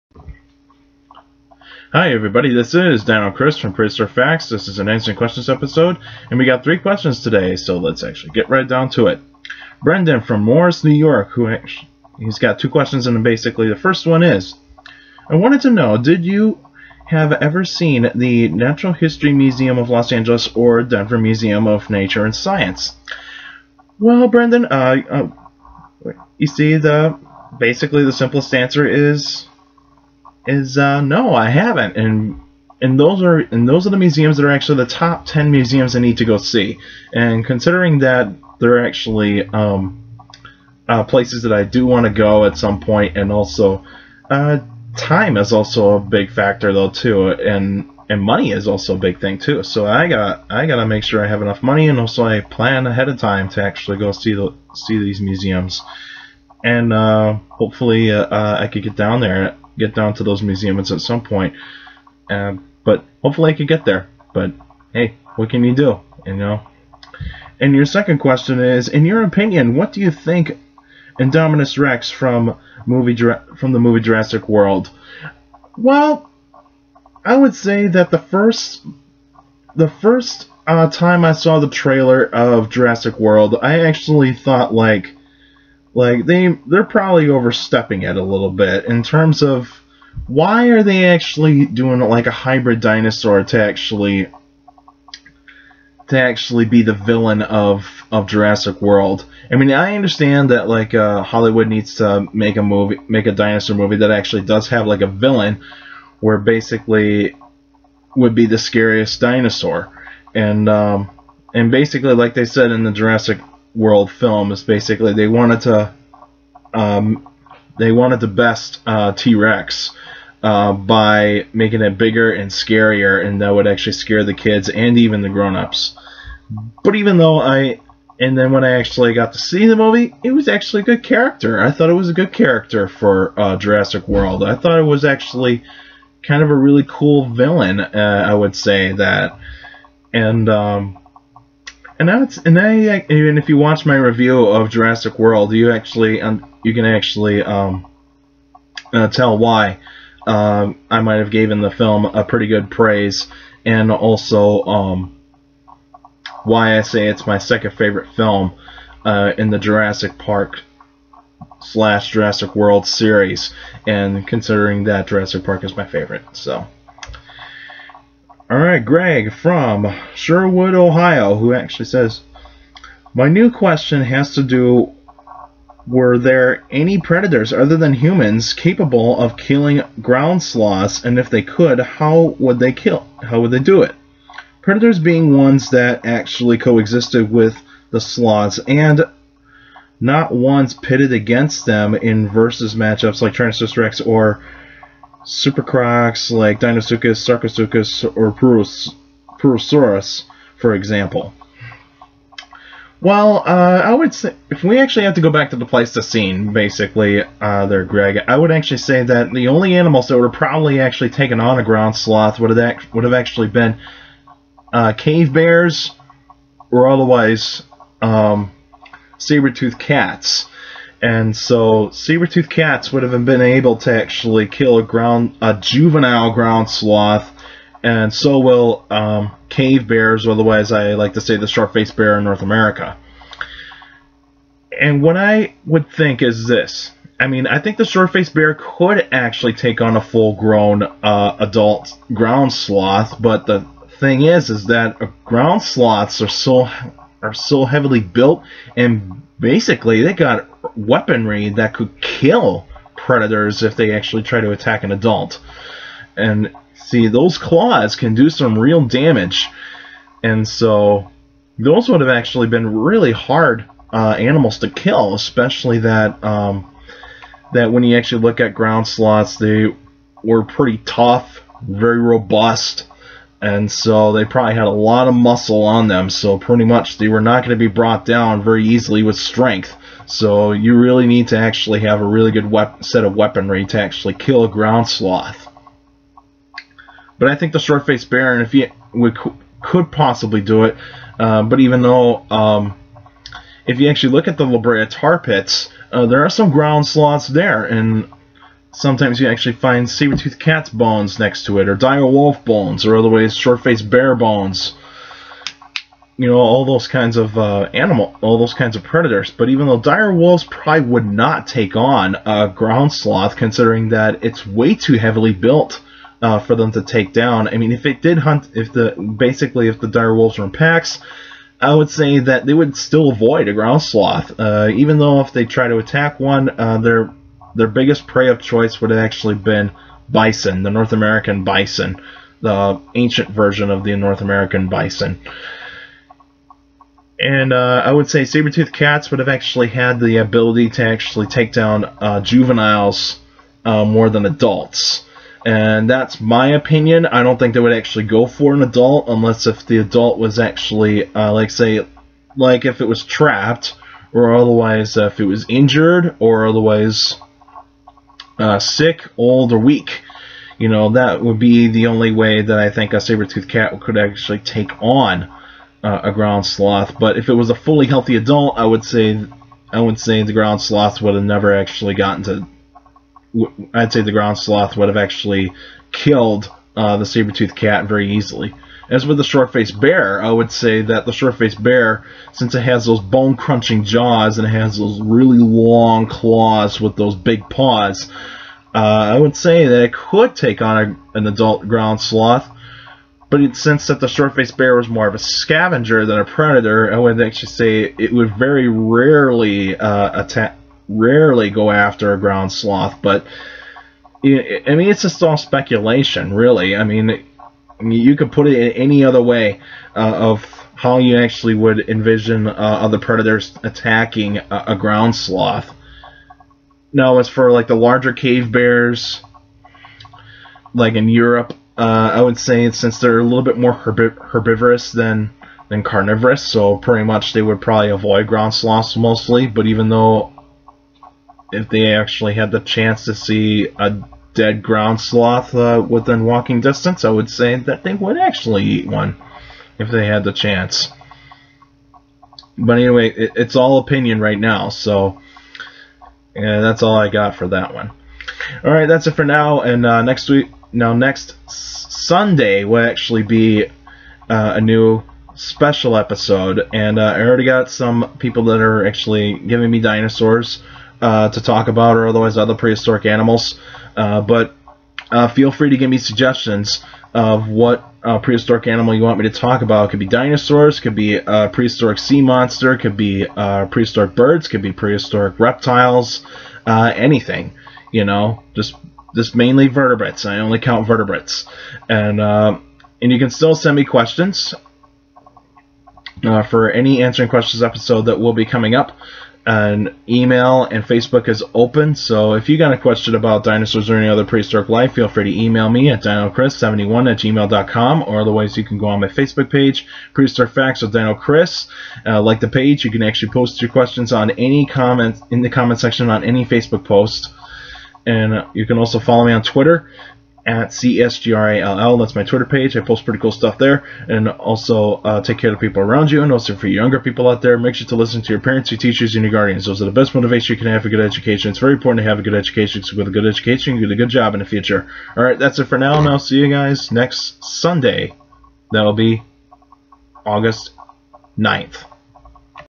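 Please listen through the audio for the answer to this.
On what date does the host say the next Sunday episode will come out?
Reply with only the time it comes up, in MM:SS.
08:50.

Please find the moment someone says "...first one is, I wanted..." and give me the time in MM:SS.
00:13.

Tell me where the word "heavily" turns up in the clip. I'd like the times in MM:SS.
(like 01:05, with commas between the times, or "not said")
04:07, 05:14.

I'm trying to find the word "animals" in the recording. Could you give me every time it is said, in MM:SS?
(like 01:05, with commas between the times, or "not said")
03:29, 04:24, 05:07, 07:43, 07:48.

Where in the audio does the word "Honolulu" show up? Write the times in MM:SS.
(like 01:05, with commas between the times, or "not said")
not said.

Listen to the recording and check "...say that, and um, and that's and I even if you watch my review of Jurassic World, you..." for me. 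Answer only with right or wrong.
right.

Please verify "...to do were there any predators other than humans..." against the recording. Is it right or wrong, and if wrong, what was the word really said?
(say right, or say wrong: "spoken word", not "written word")
right.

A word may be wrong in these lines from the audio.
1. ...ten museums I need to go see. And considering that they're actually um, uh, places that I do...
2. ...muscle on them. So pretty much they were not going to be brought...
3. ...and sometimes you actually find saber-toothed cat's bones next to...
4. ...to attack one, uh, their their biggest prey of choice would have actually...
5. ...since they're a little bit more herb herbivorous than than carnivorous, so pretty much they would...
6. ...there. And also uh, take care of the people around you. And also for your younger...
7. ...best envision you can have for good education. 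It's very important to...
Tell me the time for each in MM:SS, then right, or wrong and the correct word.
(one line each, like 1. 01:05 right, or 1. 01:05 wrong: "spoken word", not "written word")
1. 00:35 right
2. 04:35 right
3. 04:57 right
4. 05:25 right
5. 07:02 right
6. 08:33 right
7. 08:39 wrong: "motivation", not "envision".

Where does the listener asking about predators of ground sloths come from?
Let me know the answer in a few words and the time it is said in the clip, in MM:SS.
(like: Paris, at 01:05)
Sherwood, Ohio, at 02:50.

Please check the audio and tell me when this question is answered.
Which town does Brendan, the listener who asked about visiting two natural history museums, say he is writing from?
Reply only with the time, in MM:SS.
00:10.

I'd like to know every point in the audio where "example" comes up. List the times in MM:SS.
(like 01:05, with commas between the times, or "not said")
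03:20.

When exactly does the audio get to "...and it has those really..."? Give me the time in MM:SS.
06:24.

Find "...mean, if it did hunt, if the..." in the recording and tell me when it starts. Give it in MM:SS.
05:17.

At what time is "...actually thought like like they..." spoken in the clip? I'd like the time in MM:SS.
01:23.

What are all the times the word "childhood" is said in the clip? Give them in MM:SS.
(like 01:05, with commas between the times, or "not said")
not said.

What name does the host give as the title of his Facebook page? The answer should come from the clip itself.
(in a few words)
Prehistoric Facts with Dino Chris.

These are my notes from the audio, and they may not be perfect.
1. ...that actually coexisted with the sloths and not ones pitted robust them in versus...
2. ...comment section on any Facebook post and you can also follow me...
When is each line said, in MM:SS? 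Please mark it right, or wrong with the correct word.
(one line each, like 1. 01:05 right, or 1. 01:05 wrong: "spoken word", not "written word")
1. 03:05 wrong: "against", not "robust"
2. 08:25 right.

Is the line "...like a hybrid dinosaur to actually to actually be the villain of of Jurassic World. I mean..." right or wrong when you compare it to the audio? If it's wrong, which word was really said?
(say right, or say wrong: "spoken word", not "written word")
right.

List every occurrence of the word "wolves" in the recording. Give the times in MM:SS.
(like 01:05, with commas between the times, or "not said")
05:10, 05:20.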